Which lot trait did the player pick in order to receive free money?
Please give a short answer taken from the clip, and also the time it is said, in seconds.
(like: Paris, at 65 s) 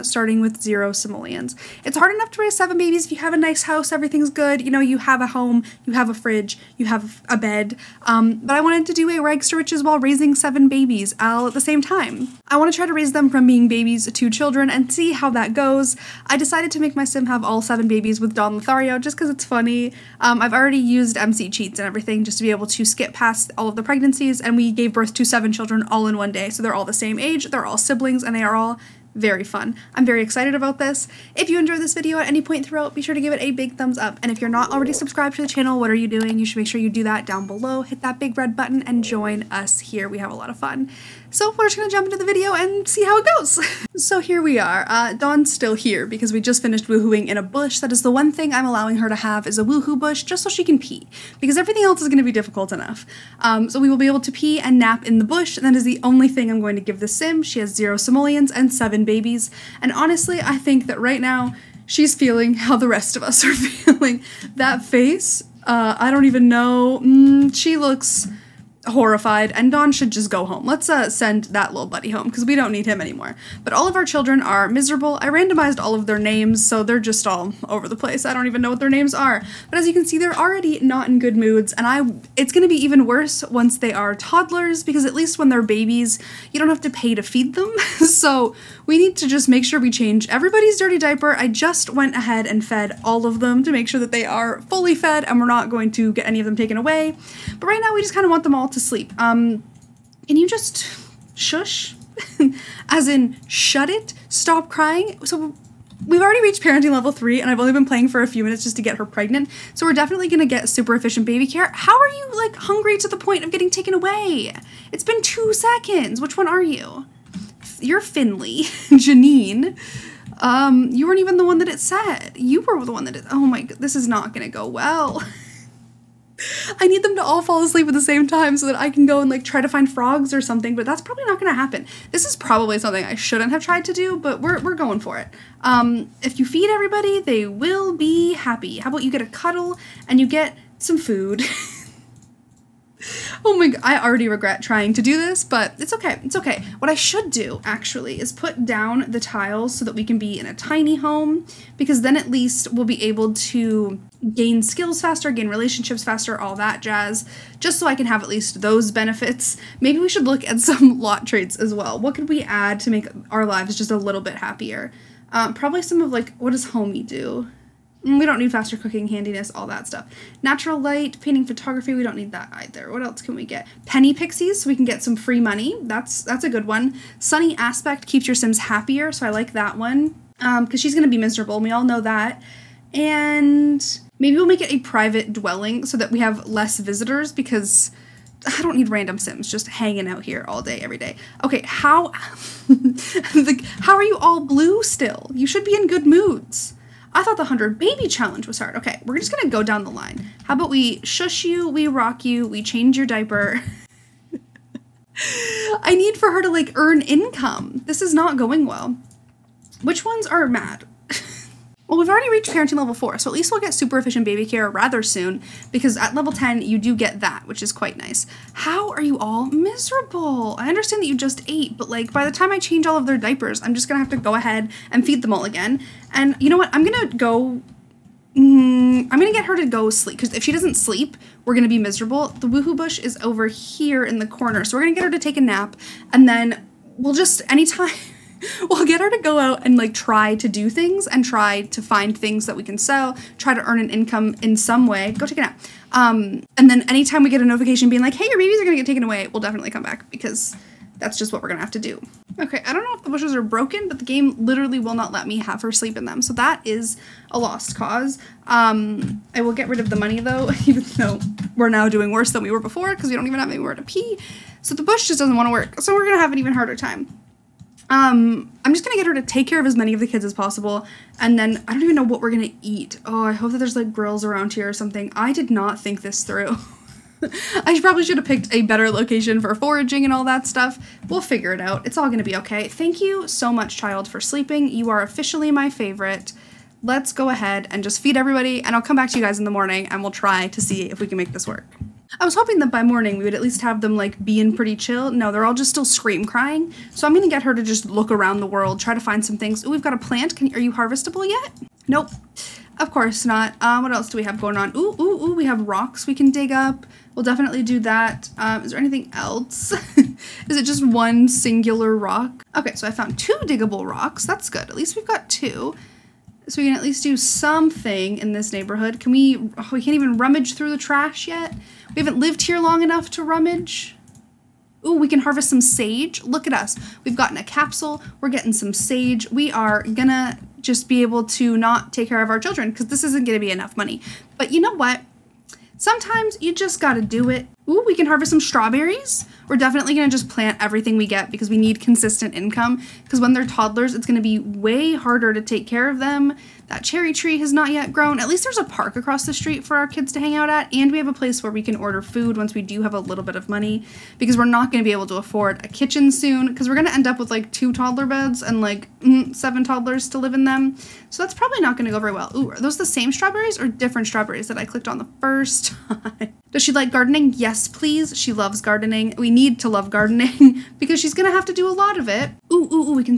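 Penny pixies, at 173 s.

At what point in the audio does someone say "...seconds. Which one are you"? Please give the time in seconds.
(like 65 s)
115 s.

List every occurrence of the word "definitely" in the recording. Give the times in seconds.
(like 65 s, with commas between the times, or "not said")
109 s, 249 s, 307 s, 339 s.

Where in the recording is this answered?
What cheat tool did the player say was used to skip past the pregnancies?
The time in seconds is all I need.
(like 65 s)
21 s.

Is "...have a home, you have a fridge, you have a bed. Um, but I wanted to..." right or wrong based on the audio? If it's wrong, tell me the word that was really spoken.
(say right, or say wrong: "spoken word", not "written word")
right.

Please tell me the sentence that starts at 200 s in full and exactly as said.
How about we shush you, we rock you, we change your diaper?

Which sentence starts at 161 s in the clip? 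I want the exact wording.
What could we add to make our lives just a little bit happier?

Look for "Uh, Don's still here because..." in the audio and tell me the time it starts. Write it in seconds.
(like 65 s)
44 s.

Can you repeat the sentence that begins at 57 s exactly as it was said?
She has zero simoleons and seven babies.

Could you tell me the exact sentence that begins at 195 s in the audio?
You should be in good moods.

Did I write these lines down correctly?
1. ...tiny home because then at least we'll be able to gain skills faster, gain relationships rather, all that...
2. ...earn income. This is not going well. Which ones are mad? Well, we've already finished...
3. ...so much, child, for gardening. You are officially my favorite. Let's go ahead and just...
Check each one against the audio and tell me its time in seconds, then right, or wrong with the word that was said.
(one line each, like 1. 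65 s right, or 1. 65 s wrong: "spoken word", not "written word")
1. 150 s wrong: "faster", not "rather"
2. 206 s wrong: "reached", not "finished"
3. 283 s wrong: "sleeping", not "gardening".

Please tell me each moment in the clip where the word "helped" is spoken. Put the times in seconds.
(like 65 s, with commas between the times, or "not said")
not said.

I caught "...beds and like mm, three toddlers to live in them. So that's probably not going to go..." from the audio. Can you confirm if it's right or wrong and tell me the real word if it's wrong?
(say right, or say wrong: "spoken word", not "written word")
wrong: "seven", not "three".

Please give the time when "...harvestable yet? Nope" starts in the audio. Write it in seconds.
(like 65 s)
300 s.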